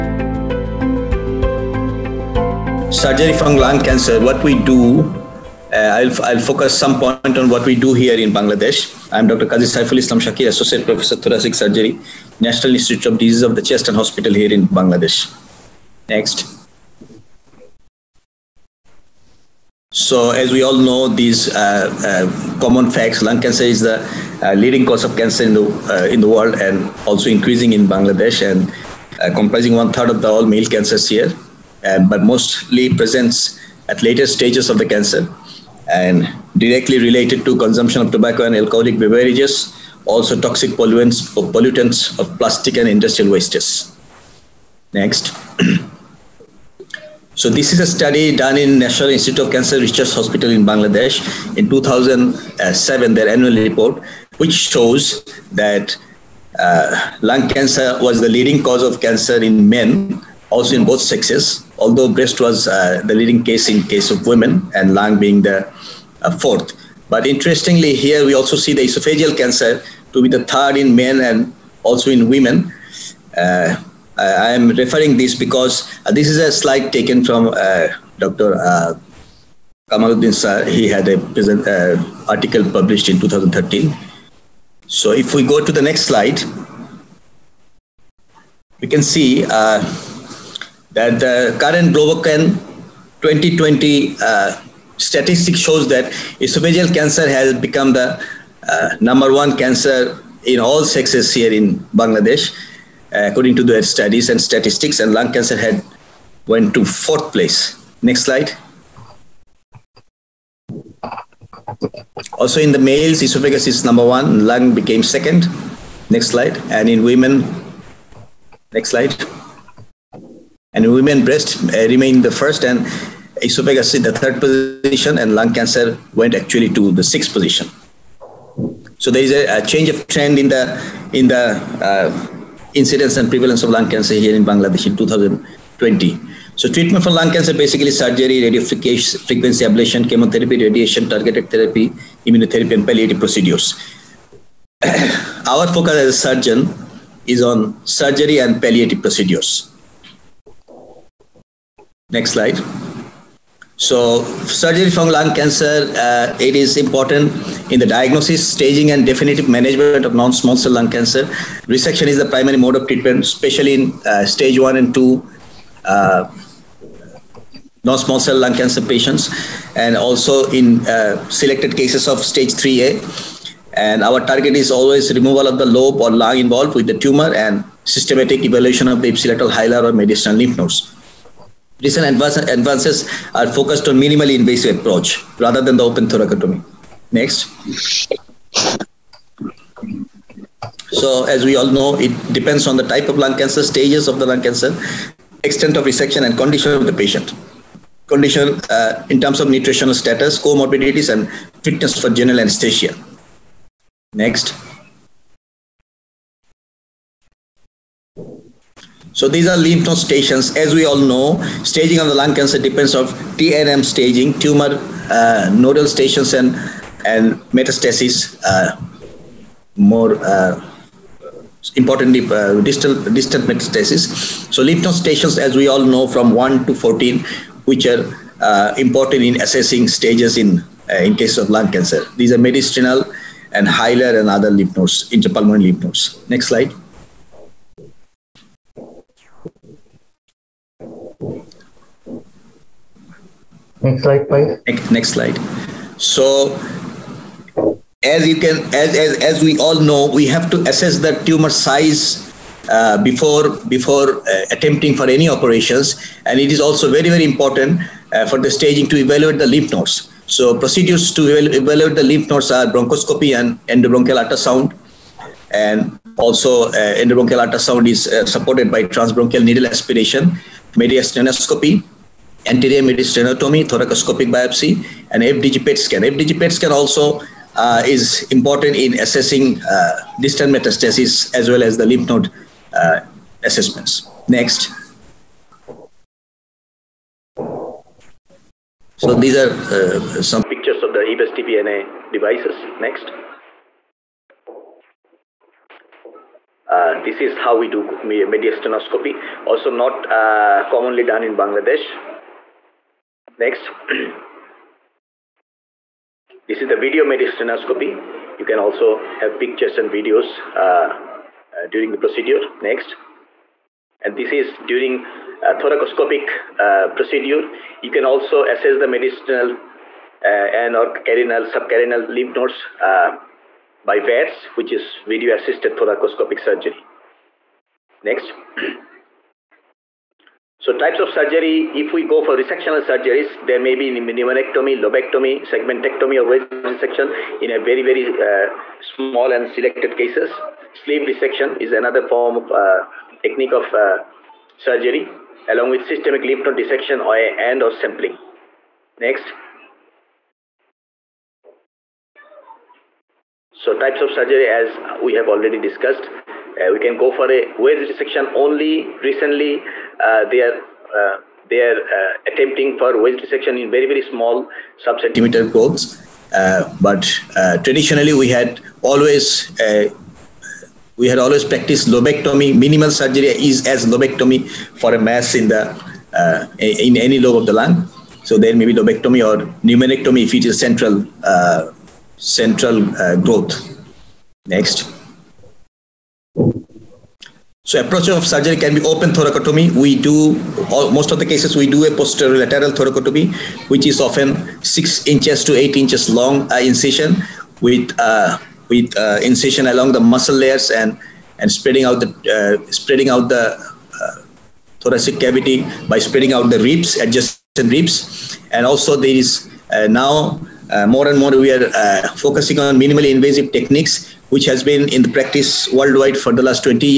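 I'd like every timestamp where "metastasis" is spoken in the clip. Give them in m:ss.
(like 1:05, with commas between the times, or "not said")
3:37, 3:43, 4:40.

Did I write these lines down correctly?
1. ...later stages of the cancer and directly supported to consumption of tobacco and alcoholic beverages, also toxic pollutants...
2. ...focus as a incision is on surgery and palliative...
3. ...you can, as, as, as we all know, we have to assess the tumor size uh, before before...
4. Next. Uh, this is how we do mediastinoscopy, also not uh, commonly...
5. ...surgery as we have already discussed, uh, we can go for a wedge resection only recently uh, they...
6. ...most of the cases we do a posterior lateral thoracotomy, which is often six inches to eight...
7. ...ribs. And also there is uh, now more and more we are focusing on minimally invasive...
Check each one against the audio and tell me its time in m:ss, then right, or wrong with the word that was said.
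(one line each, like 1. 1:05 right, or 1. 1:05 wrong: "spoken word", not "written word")
1. 0:34 wrong: "related", not "supported"
2. 2:25 wrong: "surgeon", not "incision"
3. 4:08 right
4. 4:52 right
5. 5:54 right
6. 6:30 right
7. 6:47 right.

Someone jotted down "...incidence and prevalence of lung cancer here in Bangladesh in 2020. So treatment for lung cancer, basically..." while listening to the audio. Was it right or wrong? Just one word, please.
right.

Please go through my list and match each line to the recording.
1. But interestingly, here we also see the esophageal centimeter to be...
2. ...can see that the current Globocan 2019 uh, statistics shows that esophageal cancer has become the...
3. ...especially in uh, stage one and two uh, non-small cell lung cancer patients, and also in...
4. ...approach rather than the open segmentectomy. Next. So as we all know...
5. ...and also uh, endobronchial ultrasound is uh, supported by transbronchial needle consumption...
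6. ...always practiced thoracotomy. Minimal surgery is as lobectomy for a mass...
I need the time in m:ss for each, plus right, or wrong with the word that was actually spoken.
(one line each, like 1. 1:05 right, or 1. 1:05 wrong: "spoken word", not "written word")
1. 1:07 wrong: "cancer", not "centimeter"
2. 1:28 wrong: "2020", not "2019"
3. 2:43 right
4. 3:04 wrong: "thoracotomy", not "segmentectomy"
5. 4:25 wrong: "aspiration", not "consumption"
6. 6:11 wrong: "lobectomy", not "thoracotomy".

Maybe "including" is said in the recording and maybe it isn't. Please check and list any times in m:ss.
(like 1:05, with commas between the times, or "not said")
not said.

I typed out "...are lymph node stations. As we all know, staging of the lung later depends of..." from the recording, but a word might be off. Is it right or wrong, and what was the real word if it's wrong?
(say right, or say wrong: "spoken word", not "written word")
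wrong: "cancer", not "later".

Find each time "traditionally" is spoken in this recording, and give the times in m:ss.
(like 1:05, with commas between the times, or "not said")
6:07.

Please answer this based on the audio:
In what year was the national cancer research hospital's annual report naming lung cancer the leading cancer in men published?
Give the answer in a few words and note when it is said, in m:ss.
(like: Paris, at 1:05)
2007, at 0:51.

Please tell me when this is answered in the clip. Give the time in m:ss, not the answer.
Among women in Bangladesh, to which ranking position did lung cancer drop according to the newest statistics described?
2:07.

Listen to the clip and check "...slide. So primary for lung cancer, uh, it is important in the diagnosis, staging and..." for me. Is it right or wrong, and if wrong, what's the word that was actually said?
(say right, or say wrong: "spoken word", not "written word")
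wrong: "surgery", not "primary".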